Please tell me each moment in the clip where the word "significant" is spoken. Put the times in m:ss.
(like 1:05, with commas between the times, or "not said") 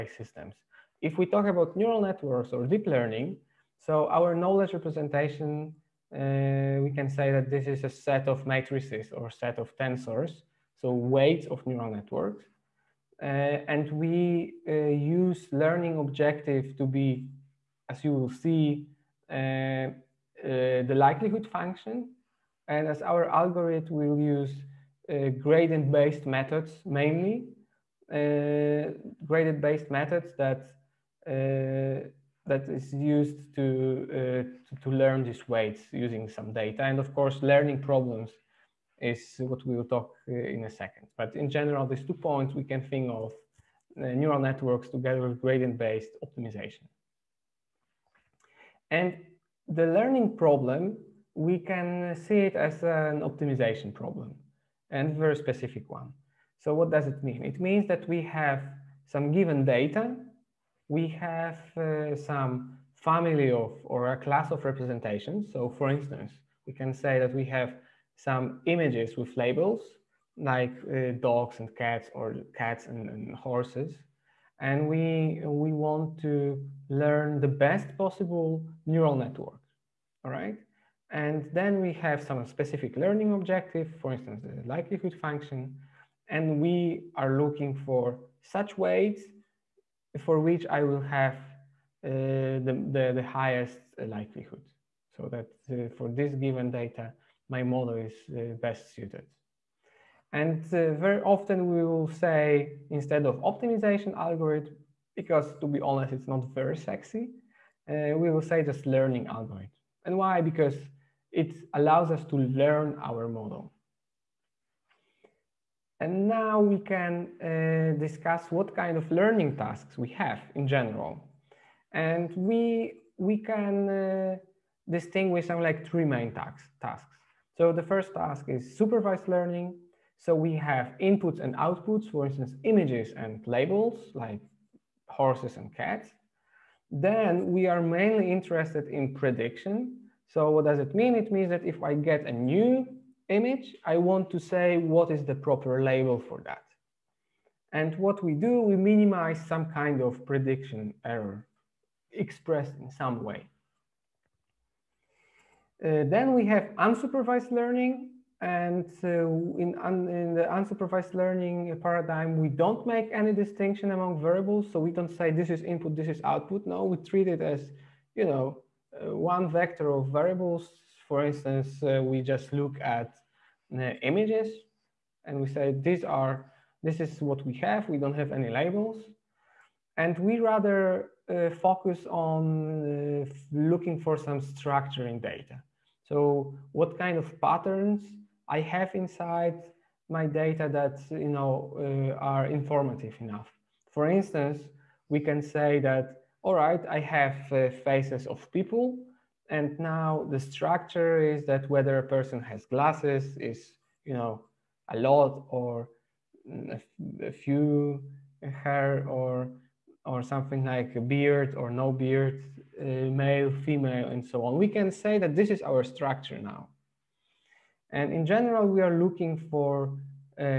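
not said.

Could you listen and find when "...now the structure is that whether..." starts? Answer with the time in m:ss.
3:19.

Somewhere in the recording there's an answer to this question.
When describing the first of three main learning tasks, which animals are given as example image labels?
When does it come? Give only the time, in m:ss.
2:15.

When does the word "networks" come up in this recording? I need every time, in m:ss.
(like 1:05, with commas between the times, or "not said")
0:02, 0:11, 0:44, 1:19.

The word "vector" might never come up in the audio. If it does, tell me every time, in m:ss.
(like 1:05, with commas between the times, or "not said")
2:49.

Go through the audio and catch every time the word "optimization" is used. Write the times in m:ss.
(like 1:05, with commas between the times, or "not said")
0:46, 0:53, 1:43.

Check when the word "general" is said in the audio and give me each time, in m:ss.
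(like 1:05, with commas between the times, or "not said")
0:41, 2:00, 3:38.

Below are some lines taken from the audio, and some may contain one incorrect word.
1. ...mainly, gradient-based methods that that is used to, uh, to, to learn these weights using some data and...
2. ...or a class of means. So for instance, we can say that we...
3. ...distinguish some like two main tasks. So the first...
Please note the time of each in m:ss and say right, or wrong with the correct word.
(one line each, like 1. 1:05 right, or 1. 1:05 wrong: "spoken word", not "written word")
1. 0:27 right
2. 1:03 wrong: "representations", not "means"
3. 2:04 wrong: "three", not "two".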